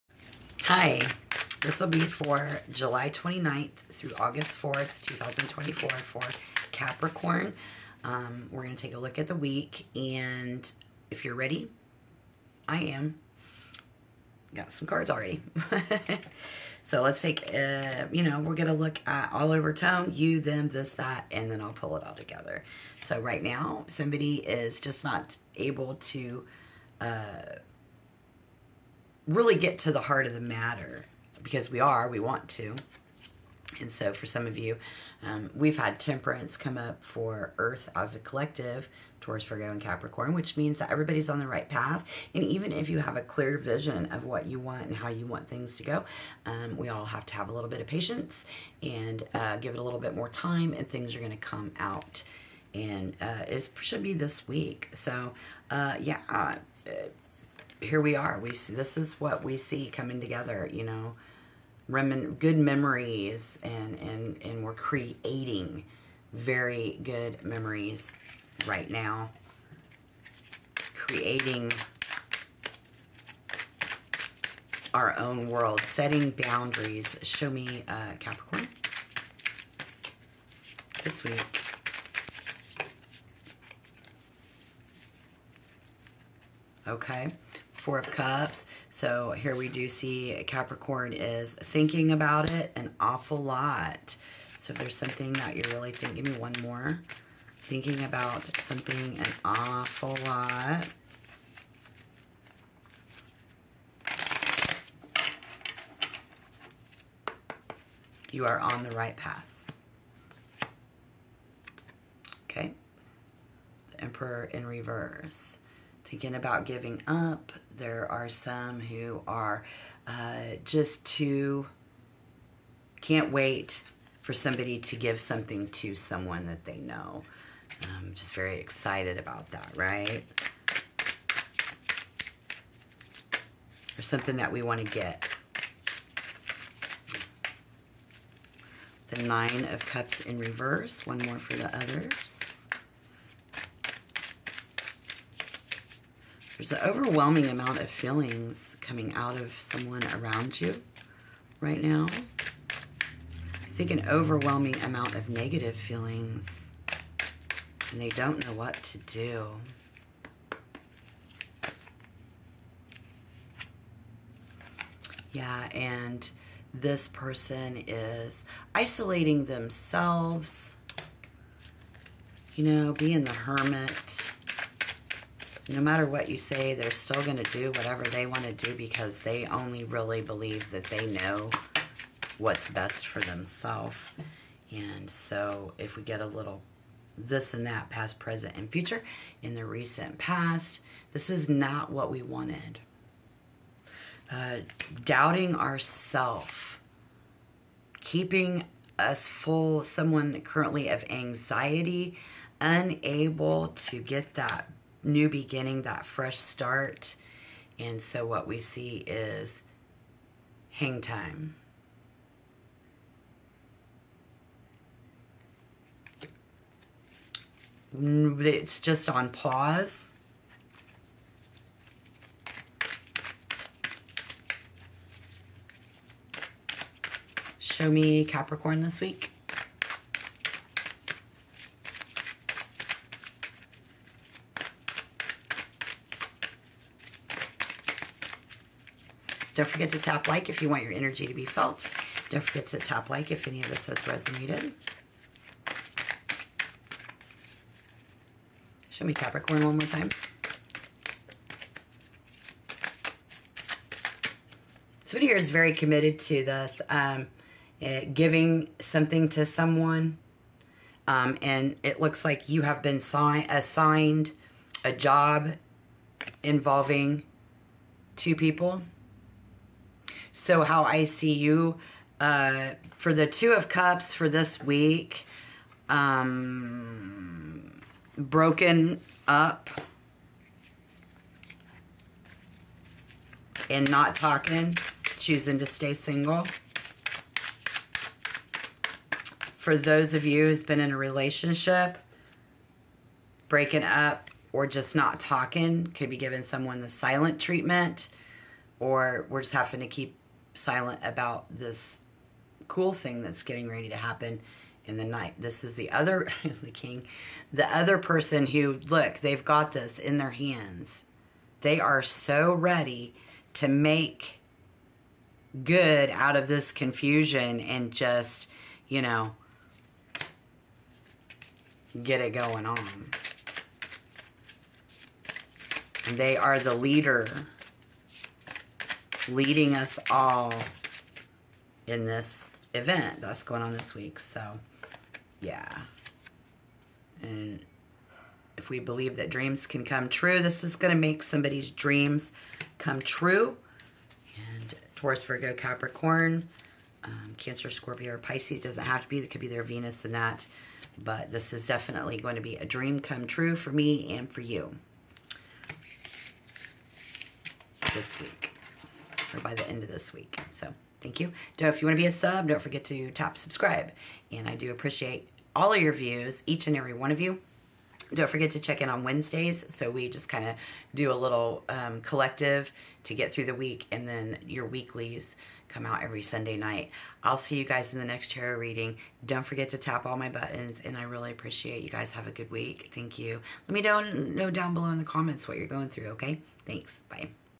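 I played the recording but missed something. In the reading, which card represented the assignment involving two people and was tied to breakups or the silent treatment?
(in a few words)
Two of Cups.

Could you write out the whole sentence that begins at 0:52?
And uh, it should be this week.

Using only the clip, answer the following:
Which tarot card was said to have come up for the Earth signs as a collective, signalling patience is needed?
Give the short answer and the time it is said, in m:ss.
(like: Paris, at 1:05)
Temperance, at 0:35.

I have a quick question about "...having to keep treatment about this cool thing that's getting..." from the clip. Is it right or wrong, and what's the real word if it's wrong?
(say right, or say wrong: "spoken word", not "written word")
wrong: "silent", not "treatment".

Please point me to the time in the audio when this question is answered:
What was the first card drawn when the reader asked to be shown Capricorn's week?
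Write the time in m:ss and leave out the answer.
1:27.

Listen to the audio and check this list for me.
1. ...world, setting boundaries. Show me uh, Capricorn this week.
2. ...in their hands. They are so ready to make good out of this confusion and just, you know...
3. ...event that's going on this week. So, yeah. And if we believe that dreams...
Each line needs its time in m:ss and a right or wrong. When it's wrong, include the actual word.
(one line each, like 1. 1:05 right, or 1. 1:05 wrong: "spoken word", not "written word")
1. 1:15 right
2. 5:09 right
3. 5:32 right.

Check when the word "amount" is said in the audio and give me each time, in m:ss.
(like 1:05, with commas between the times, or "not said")
2:27, 2:34.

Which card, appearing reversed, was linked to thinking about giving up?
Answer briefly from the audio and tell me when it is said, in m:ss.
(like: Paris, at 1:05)
The Emperor, at 1:53.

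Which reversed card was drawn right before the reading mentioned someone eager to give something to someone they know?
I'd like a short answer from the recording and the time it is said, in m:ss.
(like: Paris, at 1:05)
Nine of Cups, at 2:19.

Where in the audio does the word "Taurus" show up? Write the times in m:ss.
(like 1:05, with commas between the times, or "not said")
0:39, 5:44.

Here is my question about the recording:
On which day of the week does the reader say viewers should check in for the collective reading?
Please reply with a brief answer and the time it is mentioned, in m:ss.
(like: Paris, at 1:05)
Wednesdays, at 6:09.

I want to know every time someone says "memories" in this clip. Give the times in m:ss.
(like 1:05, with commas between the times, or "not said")
1:02, 1:07.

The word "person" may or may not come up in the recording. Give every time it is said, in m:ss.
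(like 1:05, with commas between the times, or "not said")
2:47, 5:07.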